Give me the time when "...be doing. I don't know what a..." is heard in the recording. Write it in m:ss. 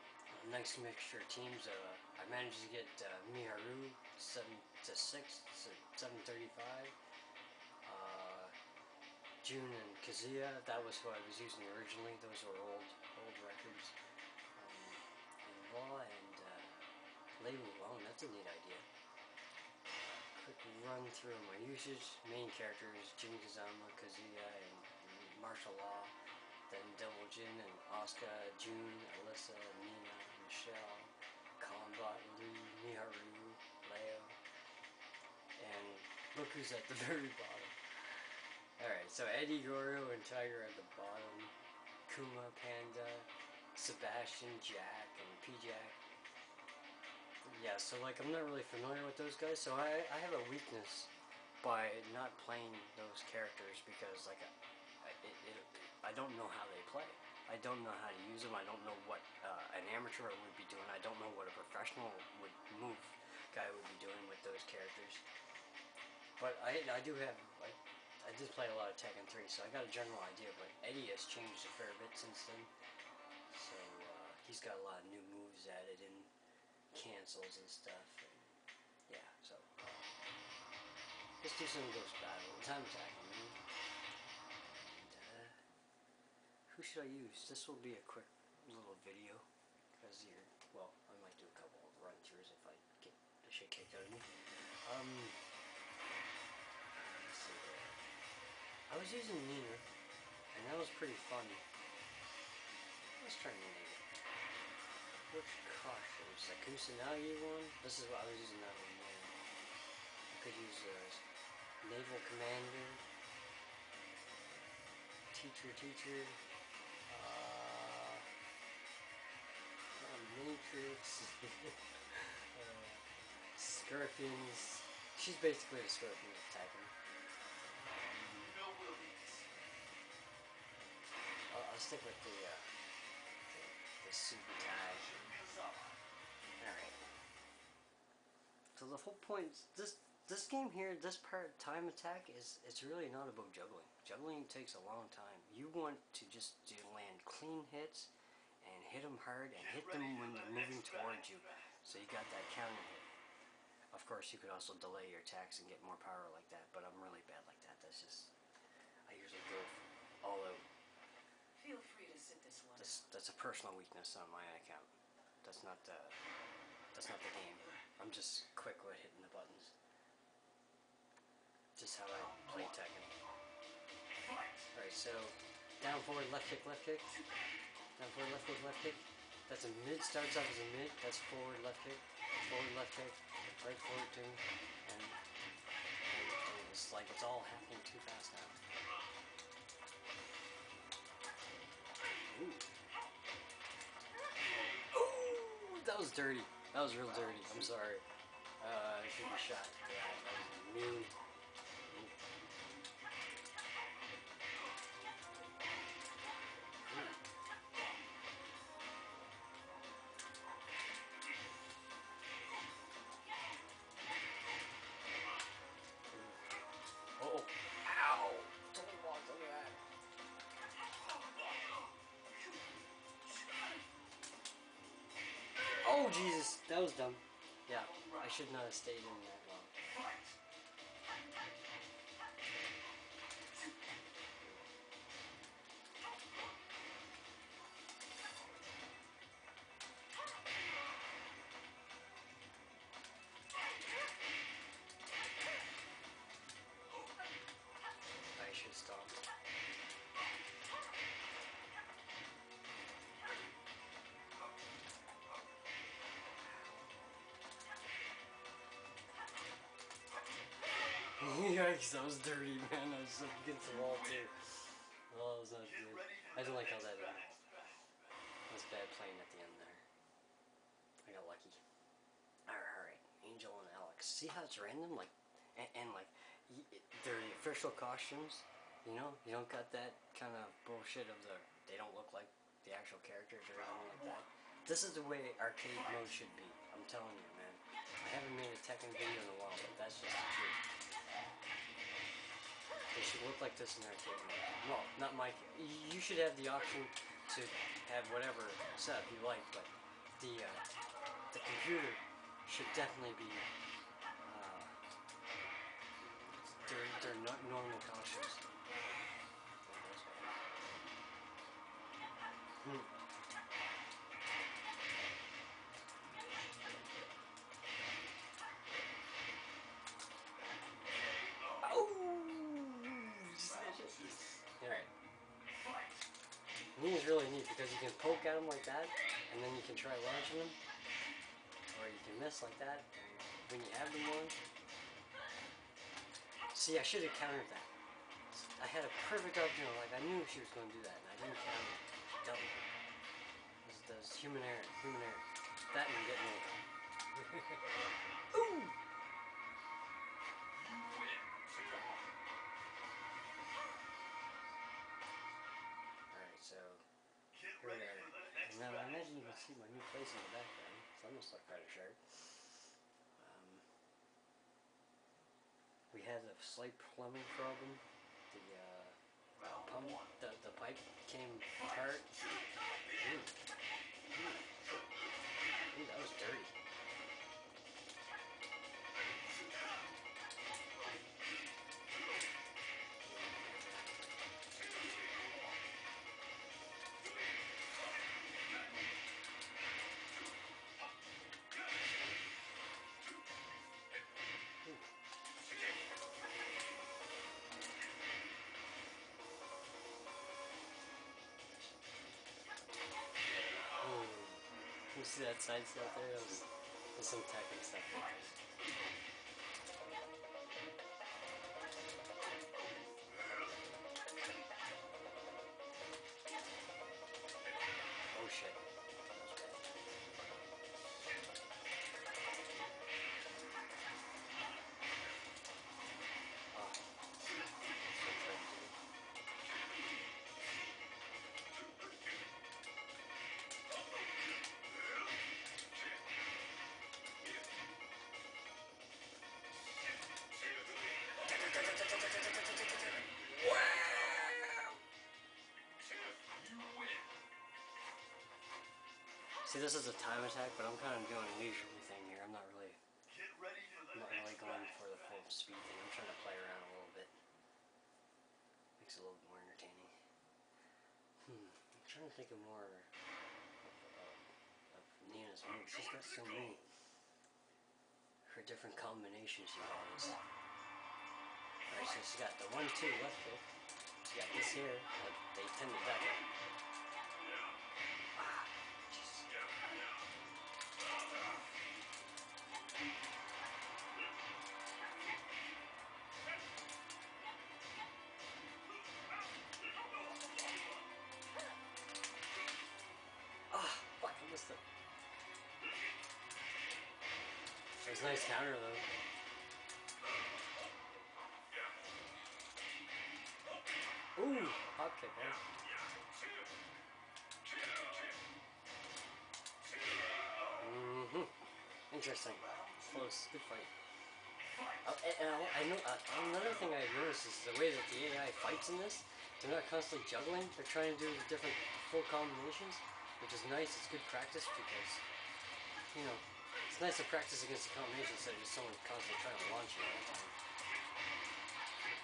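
1:00.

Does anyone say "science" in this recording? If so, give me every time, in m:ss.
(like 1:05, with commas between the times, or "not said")
not said.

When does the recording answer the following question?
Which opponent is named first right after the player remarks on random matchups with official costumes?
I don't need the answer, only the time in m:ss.
4:33.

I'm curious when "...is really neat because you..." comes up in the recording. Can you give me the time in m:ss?
5:26.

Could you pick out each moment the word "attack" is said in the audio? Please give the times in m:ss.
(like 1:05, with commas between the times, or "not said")
1:22, 2:21, 2:35, 7:30.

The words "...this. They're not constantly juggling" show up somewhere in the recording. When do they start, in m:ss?
8:38.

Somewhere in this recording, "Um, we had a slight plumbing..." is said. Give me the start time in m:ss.
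6:03.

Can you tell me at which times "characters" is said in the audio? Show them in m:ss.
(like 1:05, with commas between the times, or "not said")
0:22, 0:53, 1:04, 4:43.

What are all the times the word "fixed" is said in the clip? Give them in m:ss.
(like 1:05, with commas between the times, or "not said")
not said.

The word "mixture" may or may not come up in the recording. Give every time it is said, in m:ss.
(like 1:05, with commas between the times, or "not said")
0:00.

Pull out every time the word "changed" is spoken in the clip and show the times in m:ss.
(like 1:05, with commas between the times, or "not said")
1:11.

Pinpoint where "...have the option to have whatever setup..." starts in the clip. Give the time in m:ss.
4:56.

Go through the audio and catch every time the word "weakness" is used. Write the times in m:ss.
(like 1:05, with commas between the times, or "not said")
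0:50, 2:43.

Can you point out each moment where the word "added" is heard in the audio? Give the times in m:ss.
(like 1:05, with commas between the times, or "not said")
1:15.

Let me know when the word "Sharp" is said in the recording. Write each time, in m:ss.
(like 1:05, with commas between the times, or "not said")
6:01.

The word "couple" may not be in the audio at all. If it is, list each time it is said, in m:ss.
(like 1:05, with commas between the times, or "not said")
1:31.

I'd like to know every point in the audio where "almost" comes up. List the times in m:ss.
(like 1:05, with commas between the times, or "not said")
6:01.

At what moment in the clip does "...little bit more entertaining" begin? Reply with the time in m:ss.
7:39.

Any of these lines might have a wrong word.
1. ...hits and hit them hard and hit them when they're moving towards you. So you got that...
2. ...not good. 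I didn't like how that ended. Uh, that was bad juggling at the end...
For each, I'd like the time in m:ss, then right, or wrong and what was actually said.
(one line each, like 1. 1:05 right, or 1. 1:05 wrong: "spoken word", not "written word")
1. 2:27 right
2. 4:25 wrong: "playing", not "juggling".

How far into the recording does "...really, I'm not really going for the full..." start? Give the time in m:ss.
7:32.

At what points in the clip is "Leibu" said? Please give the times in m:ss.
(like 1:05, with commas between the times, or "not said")
0:17.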